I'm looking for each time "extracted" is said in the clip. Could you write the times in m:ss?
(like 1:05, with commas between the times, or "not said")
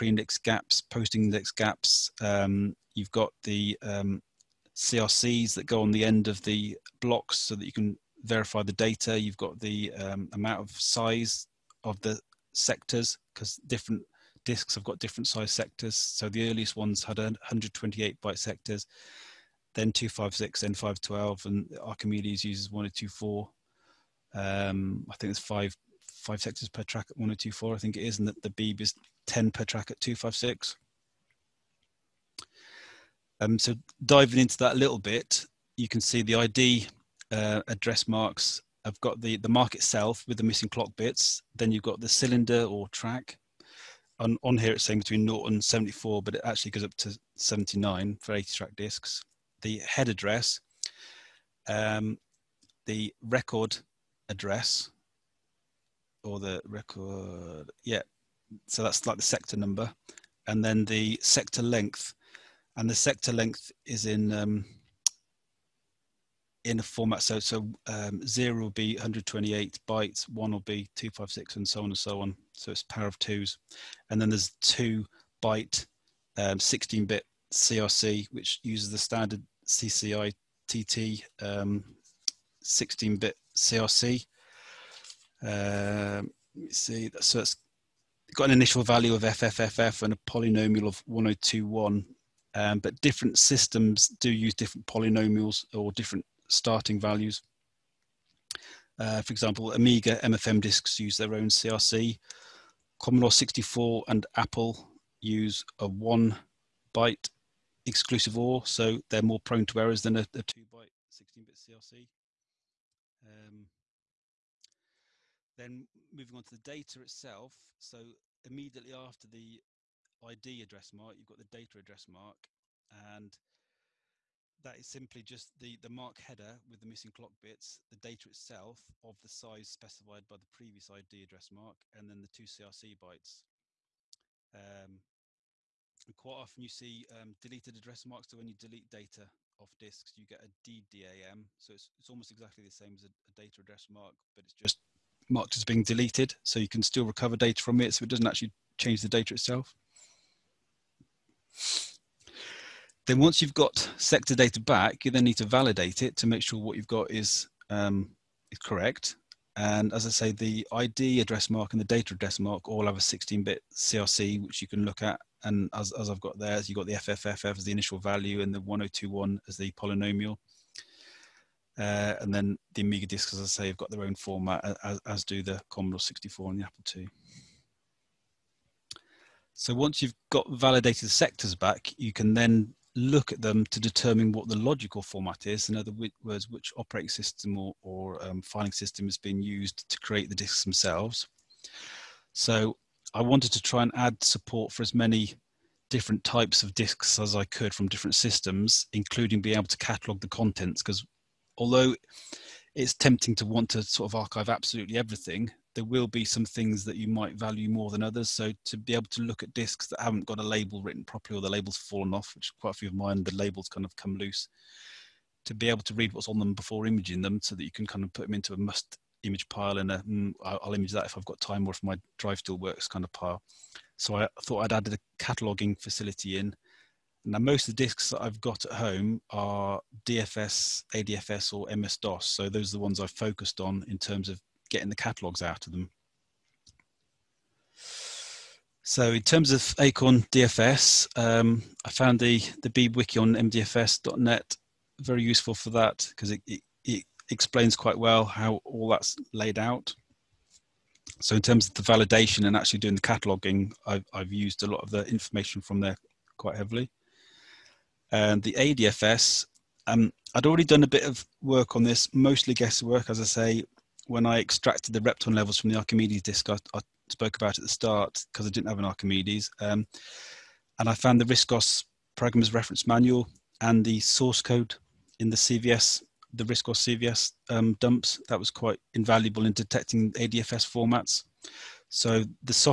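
4:24.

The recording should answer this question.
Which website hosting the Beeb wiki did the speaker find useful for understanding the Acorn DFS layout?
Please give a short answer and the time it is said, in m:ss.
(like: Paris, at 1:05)
mdfs.net, at 4:03.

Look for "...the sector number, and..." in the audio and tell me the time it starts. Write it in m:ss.
0:59.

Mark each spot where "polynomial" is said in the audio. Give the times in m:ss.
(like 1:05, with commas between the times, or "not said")
1:30, 1:34, 2:49.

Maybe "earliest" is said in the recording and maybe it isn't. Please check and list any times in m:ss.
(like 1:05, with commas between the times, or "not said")
0:16.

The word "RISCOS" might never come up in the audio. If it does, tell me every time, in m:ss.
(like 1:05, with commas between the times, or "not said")
4:31, 4:36.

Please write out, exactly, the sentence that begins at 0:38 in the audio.
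I've got the, the mark itself with the missing clock bits.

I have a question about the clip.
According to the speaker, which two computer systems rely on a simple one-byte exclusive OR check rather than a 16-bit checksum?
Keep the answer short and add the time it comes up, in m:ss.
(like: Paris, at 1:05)
Commodore 64 and Apple, at 1:43.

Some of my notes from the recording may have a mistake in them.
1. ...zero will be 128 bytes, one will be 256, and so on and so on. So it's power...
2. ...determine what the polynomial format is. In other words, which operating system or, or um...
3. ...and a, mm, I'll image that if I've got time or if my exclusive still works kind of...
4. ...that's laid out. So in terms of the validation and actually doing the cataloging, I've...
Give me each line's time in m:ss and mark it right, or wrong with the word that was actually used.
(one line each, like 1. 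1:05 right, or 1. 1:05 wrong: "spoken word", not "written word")
1. 1:08 right
2. 3:03 wrong: "logical", not "polynomial"
3. 3:39 wrong: "drive", not "exclusive"
4. 4:08 right.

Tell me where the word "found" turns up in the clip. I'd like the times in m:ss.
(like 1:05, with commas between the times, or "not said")
4:01, 4:30.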